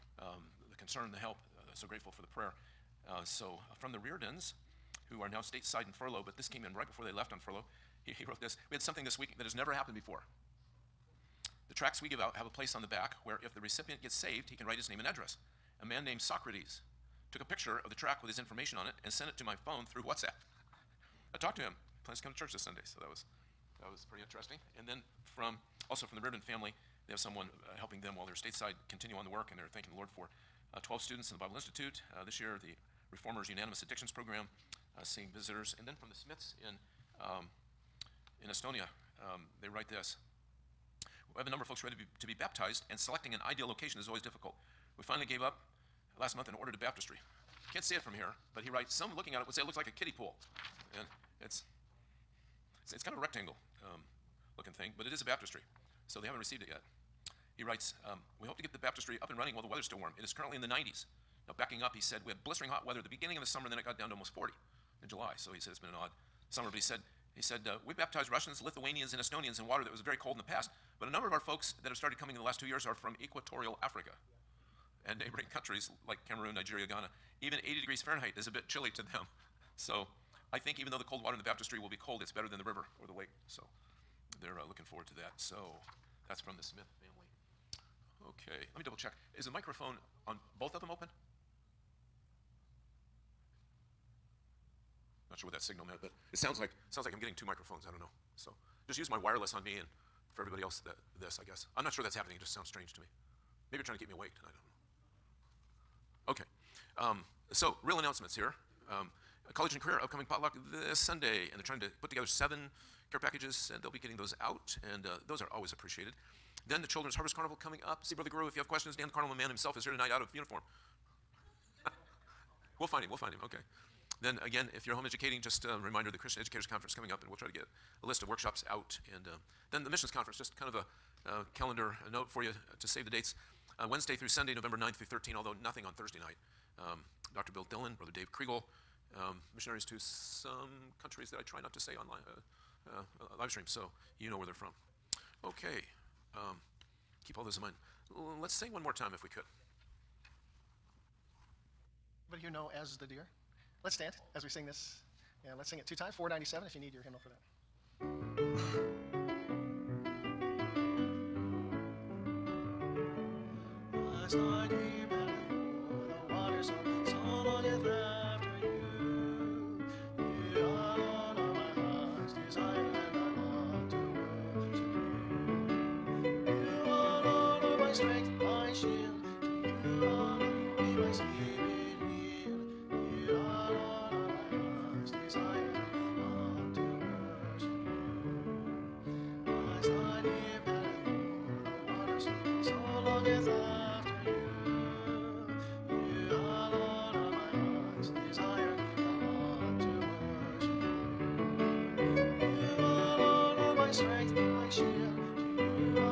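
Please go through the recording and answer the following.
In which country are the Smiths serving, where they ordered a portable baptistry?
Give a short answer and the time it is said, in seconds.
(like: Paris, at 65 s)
Estonia, at 38 s.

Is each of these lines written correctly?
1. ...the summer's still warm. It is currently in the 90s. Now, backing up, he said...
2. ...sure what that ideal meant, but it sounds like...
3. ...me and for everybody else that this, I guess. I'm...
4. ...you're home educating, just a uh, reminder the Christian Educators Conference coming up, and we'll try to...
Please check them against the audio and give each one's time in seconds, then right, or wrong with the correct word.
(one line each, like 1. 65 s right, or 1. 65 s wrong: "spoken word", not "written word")
1. 59 s wrong: "weather", not "summer"
2. 95 s wrong: "signal", not "ideal"
3. 99 s right
4. 124 s right.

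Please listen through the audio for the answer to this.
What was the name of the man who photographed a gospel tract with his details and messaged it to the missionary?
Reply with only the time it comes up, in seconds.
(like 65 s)
16 s.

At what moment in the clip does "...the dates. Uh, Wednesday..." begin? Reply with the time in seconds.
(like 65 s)
133 s.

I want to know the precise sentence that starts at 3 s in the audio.
Uh, so, uh, from the Reardons, who are now stateside in furlough, but this came in right before they left on furlough.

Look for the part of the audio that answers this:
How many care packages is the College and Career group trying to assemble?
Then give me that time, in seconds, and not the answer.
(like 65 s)
112 s.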